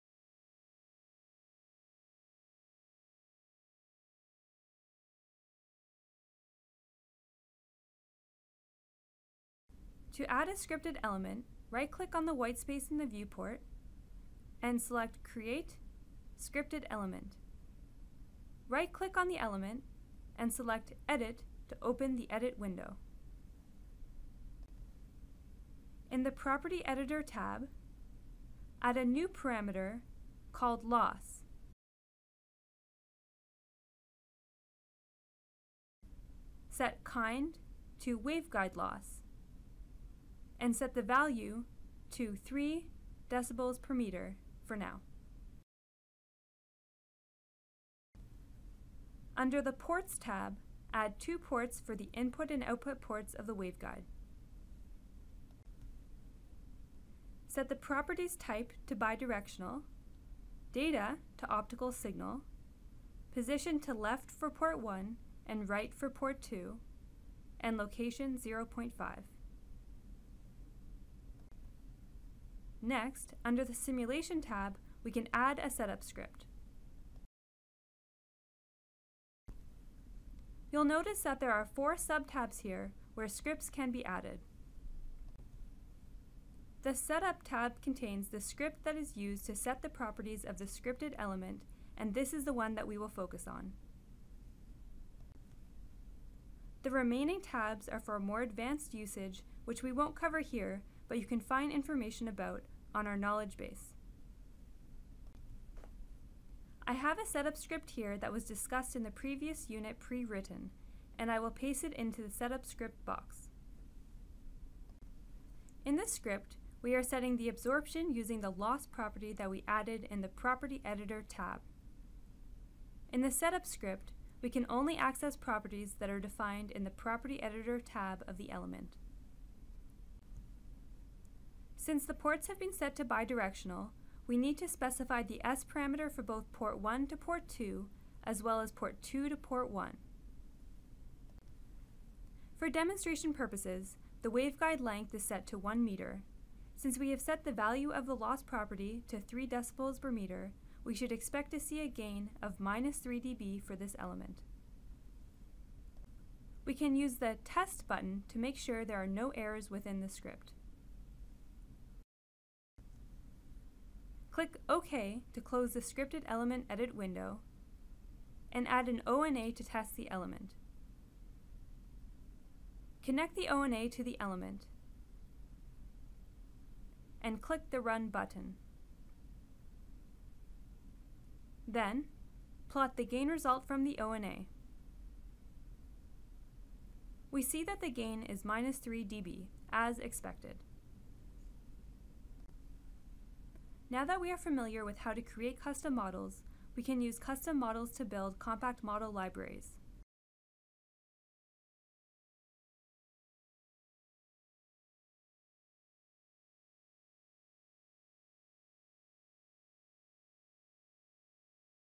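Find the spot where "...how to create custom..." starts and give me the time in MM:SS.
03:14.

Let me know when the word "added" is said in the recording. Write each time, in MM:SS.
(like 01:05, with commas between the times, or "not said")
01:24, 01:59.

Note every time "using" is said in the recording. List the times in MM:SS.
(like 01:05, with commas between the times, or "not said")
01:58.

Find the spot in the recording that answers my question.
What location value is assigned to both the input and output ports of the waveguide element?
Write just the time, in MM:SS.
01:08.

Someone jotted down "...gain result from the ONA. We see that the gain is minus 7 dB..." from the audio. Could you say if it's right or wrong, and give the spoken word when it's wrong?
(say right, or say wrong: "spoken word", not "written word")
wrong: "3", not "7".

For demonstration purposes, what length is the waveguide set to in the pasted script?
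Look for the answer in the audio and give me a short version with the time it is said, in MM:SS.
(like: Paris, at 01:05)
1 meter, at 02:25.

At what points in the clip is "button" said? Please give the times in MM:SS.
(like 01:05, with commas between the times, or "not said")
02:37, 02:58.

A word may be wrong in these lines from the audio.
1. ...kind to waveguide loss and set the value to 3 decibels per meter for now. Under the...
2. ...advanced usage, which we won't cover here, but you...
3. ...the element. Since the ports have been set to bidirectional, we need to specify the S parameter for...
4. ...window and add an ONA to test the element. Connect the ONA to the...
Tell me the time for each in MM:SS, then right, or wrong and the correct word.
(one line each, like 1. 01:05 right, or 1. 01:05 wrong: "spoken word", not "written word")
1. 00:37 right
2. 01:38 right
3. 02:08 right
4. 02:46 right.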